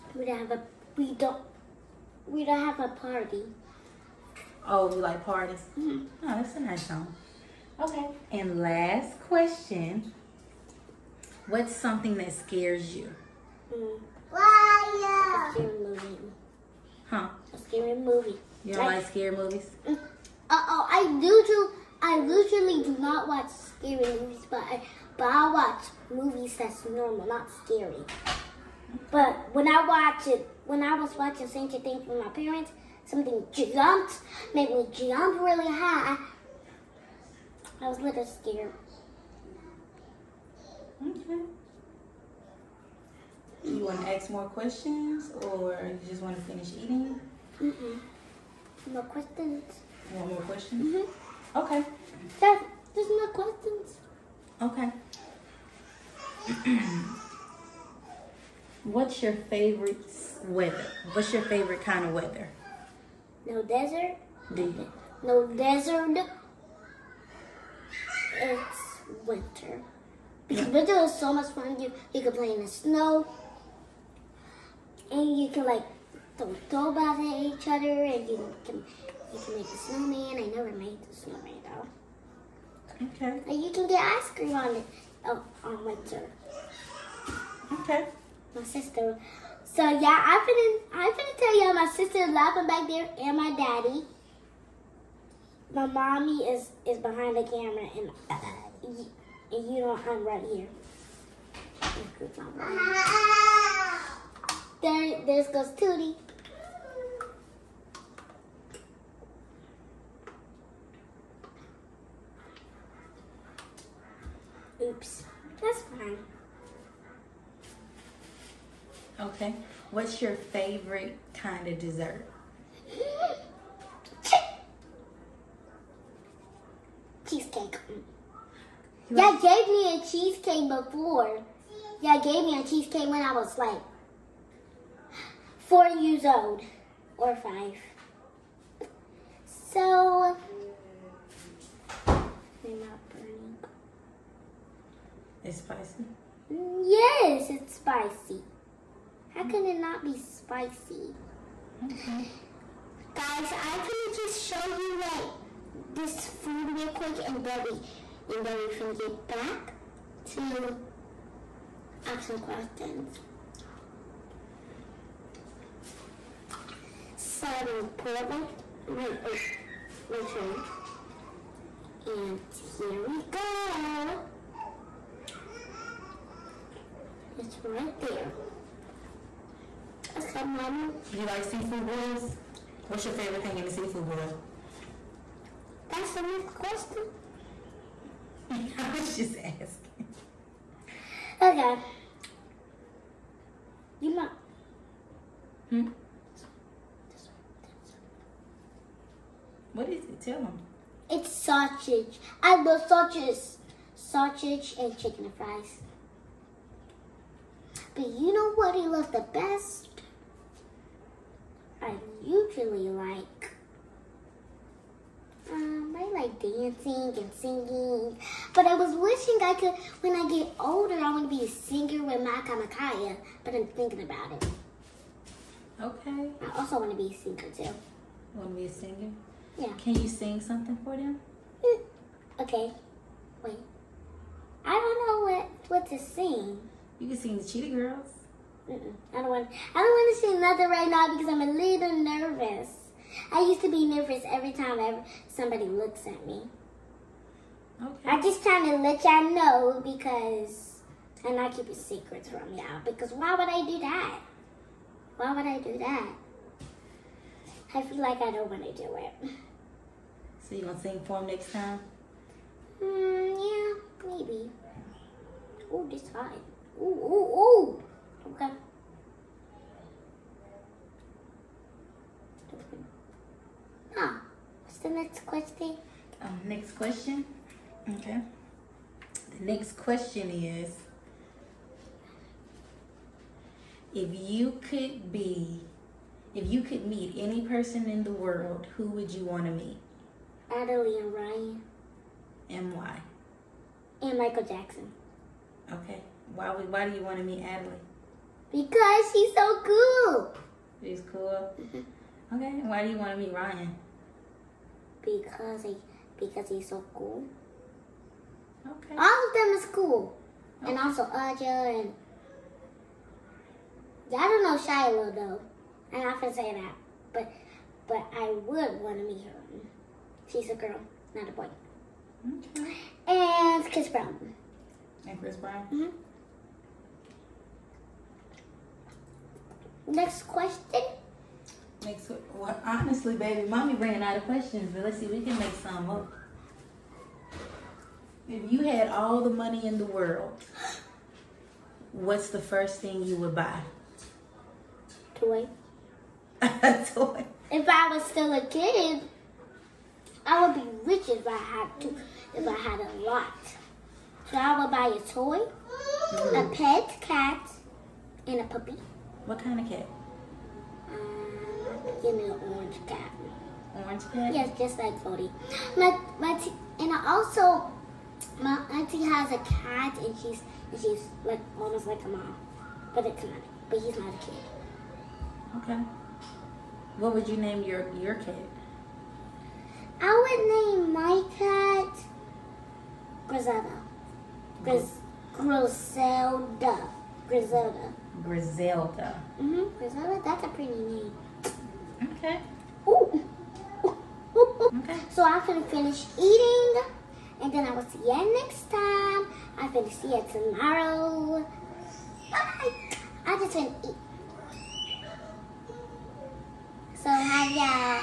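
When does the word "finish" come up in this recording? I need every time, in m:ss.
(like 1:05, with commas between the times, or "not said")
0:46, 6:35.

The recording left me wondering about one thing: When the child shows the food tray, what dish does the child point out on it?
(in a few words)
Ramen.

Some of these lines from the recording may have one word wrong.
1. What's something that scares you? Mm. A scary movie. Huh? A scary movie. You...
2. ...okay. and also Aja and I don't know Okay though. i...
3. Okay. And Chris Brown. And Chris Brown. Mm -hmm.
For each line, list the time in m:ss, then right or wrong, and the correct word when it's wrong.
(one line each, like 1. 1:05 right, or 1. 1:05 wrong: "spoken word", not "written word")
1. 0:11 right
2. 5:10 wrong: "Shiloh", not "Okay"
3. 5:22 right.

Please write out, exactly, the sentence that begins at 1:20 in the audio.
I never made the snowman though.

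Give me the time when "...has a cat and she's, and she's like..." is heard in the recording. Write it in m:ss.
6:09.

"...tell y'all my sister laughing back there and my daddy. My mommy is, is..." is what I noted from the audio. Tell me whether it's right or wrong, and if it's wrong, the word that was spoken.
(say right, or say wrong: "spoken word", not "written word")
right.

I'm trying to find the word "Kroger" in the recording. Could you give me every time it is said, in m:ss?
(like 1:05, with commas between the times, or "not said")
not said.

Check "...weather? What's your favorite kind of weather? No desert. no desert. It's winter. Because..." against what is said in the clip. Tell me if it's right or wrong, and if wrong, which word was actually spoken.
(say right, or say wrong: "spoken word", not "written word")
right.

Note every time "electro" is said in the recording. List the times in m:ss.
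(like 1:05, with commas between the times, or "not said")
not said.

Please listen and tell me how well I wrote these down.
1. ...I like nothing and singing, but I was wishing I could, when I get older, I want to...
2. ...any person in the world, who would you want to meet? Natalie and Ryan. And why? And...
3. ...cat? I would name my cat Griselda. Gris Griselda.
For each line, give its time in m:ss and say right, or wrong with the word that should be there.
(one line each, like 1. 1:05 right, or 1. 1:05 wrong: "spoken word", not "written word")
1. 3:35 wrong: "dancing", not "nothing"
2. 4:47 right
3. 6:18 right.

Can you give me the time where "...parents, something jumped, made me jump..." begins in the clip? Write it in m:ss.
0:32.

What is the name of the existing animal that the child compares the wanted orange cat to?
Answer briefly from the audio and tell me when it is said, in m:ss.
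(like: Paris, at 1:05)
Cody, at 6:05.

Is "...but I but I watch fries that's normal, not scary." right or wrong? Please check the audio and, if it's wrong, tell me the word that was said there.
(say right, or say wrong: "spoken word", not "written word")
wrong: "movies", not "fries".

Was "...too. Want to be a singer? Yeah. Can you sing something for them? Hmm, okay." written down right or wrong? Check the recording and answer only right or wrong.
right.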